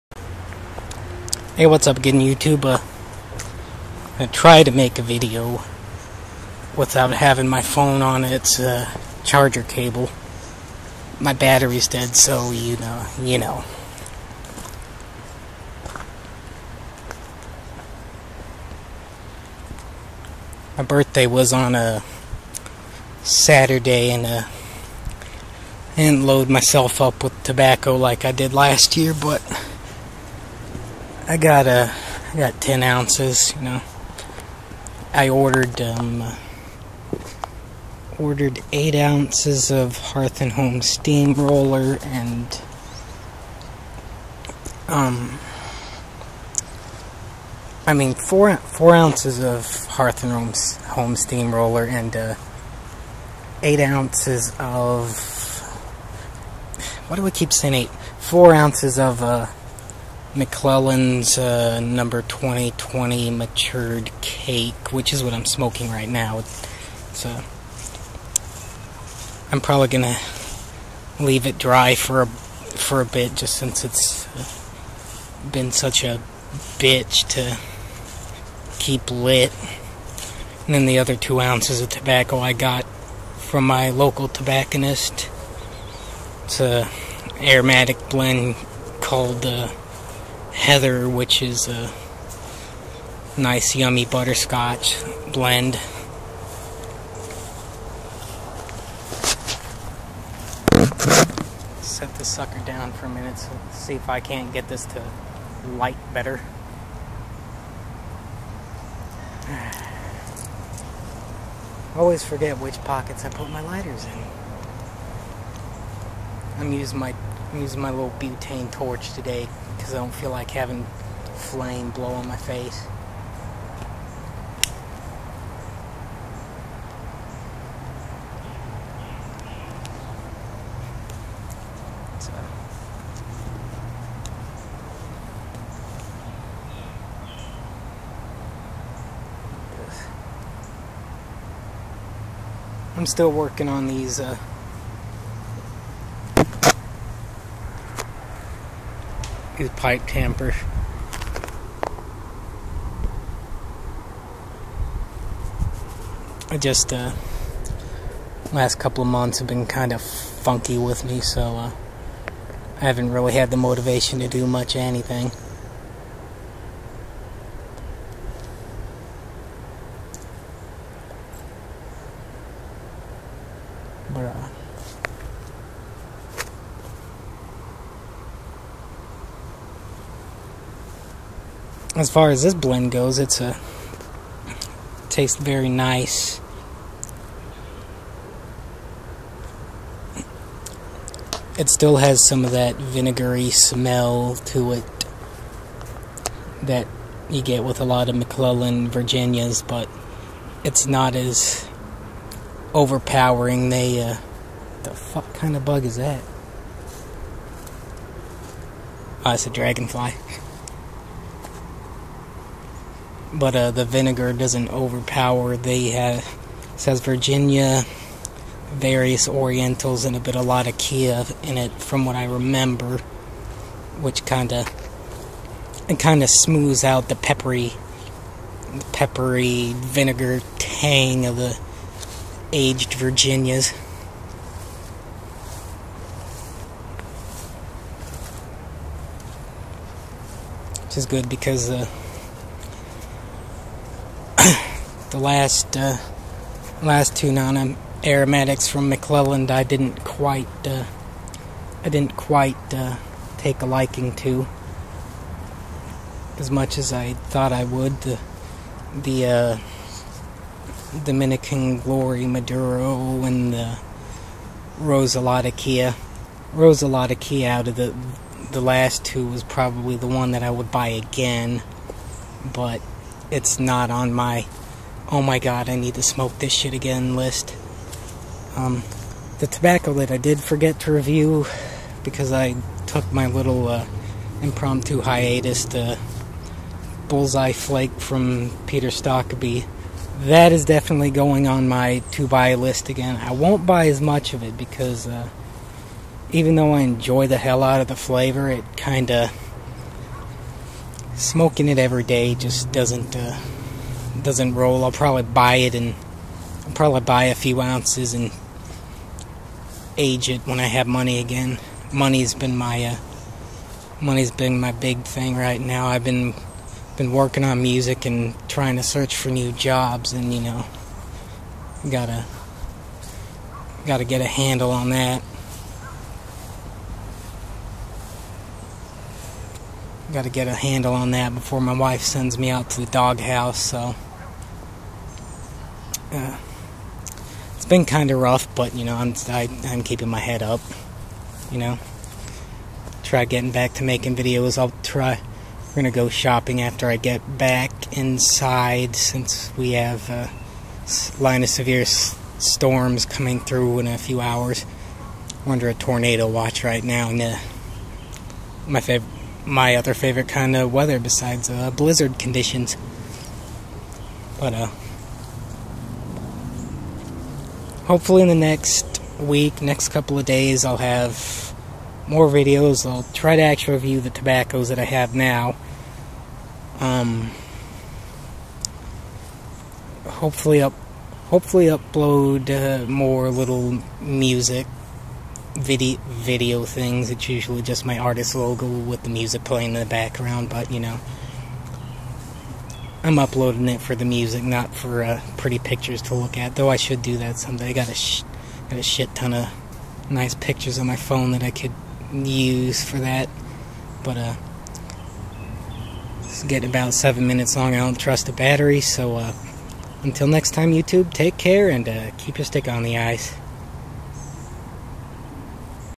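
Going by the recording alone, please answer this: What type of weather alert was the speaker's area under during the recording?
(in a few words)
Tornado watch.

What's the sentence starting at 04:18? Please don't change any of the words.
The the uh, Dominican Glory Maduro and the Rose of Latakia.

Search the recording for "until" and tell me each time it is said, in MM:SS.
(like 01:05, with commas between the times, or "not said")
06:50.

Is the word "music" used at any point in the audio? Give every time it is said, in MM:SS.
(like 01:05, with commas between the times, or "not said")
05:17, 06:24, 06:29, 06:34.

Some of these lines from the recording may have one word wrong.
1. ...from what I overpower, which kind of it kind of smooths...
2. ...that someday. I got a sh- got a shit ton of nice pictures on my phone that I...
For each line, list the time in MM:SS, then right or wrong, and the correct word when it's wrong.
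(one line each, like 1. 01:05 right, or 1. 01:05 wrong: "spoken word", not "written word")
1. 03:41 wrong: "remember", not "overpower"
2. 06:37 right.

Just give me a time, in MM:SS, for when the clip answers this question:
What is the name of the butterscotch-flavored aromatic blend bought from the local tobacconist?
01:30.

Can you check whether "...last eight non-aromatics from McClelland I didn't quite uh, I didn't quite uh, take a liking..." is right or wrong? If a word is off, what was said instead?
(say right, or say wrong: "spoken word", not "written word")
wrong: "two", not "eight".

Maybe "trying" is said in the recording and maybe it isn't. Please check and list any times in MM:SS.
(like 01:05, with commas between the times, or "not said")
05:18.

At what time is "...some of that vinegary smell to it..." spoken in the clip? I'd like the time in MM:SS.
03:12.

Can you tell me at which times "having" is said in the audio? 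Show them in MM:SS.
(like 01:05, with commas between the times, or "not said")
00:07, 02:00.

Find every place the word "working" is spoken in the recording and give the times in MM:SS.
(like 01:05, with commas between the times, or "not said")
02:23, 05:17.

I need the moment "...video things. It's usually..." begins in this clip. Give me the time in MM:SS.
06:26.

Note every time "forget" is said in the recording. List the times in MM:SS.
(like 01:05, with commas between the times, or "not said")
01:52, 04:40.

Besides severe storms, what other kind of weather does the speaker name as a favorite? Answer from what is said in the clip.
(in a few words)
Blizzard conditions.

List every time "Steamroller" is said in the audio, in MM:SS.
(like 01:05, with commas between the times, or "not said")
00:40, 00:51.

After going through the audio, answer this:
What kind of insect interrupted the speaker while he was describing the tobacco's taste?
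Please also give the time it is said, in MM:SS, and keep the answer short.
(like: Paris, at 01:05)
Dragonfly, at 03:29.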